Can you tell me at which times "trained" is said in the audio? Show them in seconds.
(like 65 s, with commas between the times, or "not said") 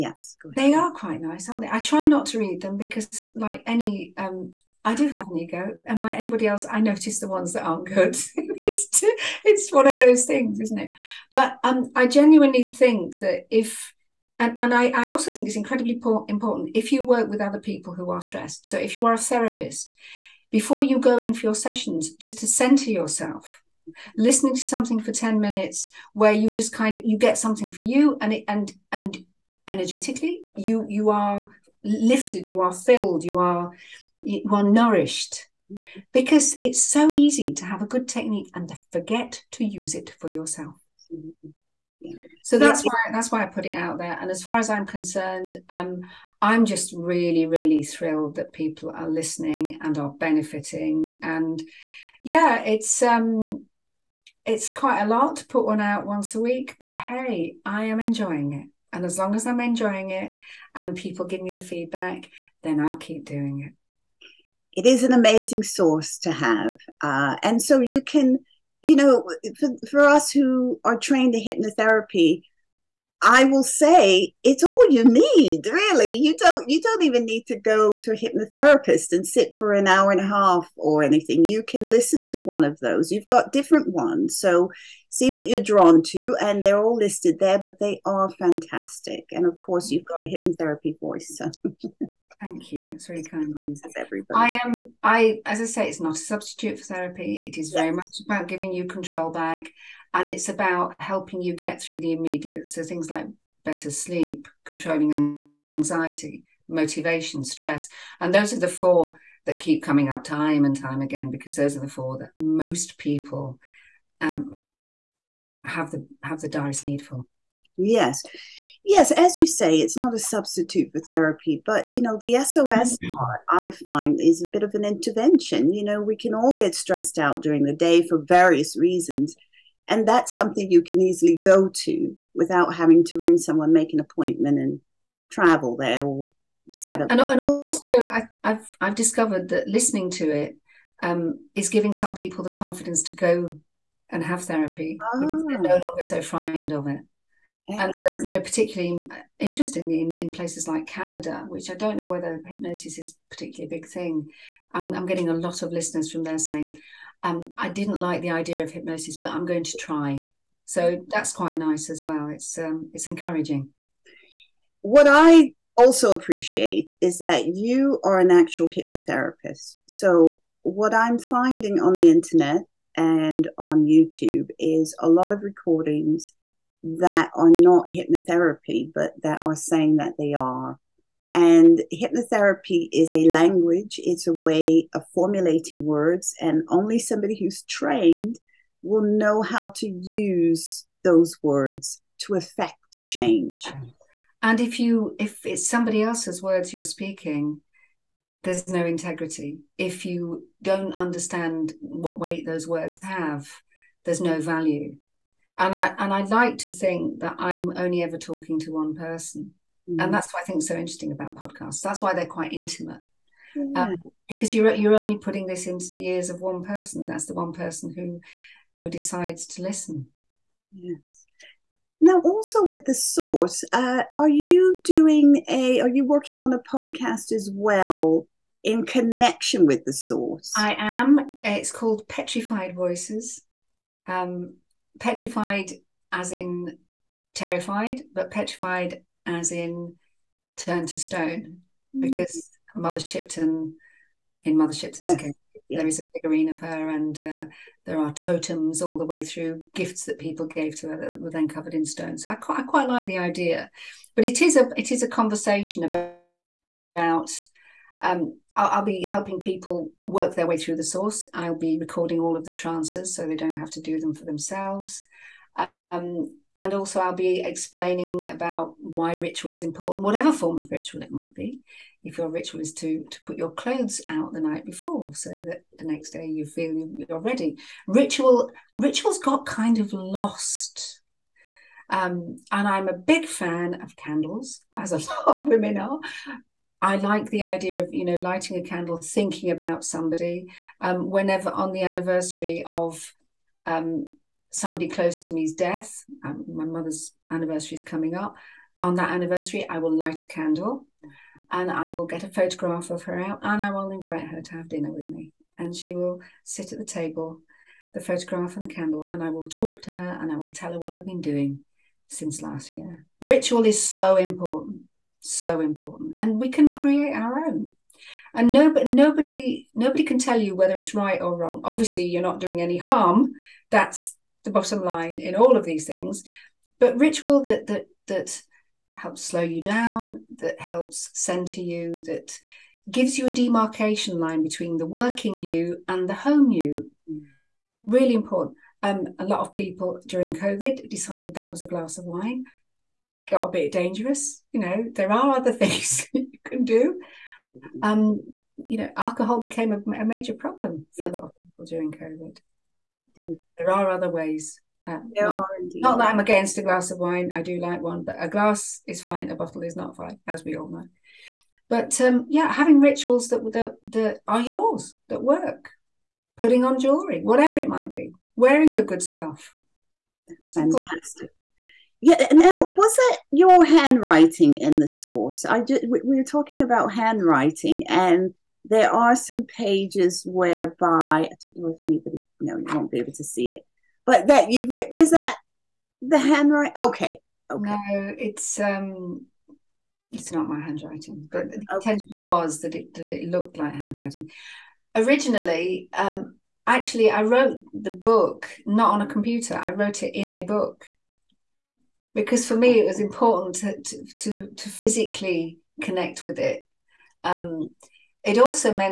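70 s, 187 s.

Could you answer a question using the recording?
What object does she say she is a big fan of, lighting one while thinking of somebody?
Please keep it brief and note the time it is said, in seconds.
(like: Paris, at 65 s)
Candles, at 283 s.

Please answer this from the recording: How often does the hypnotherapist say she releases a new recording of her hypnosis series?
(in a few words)
Once a week.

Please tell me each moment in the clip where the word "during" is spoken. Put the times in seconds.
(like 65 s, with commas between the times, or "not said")
127 s, 340 s, 351 s.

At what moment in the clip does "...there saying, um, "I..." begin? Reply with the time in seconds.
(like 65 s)
156 s.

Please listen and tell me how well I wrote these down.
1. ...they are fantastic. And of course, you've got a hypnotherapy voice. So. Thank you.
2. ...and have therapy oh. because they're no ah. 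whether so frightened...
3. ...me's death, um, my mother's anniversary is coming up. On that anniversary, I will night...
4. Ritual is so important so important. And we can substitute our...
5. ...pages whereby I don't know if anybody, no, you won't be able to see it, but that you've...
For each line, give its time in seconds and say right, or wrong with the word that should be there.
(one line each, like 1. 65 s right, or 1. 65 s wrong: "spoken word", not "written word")
1. 87 s right
2. 144 s wrong: "longer", not "whether"
3. 295 s wrong: "light", not "night"
4. 313 s wrong: "create", not "substitute"
5. 379 s right.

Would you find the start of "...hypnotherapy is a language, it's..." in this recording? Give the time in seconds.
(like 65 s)
181 s.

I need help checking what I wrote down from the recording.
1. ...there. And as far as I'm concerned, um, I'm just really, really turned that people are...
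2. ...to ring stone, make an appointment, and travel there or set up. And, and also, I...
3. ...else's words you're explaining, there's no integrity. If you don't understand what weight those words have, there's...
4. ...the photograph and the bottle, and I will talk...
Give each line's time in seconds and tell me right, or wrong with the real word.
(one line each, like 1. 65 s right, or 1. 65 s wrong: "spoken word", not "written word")
1. 43 s wrong: "thrilled", not "turned"
2. 133 s wrong: "someone", not "stone"
3. 196 s wrong: "speaking", not "explaining"
4. 307 s wrong: "candle", not "bottle".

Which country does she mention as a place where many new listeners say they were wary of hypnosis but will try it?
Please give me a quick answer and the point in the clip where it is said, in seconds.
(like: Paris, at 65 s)
Canada, at 150 s.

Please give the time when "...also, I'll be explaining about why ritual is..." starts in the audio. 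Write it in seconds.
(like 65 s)
266 s.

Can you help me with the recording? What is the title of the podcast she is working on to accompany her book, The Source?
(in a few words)
Petrified Voices.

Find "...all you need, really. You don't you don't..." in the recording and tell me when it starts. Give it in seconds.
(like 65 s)
74 s.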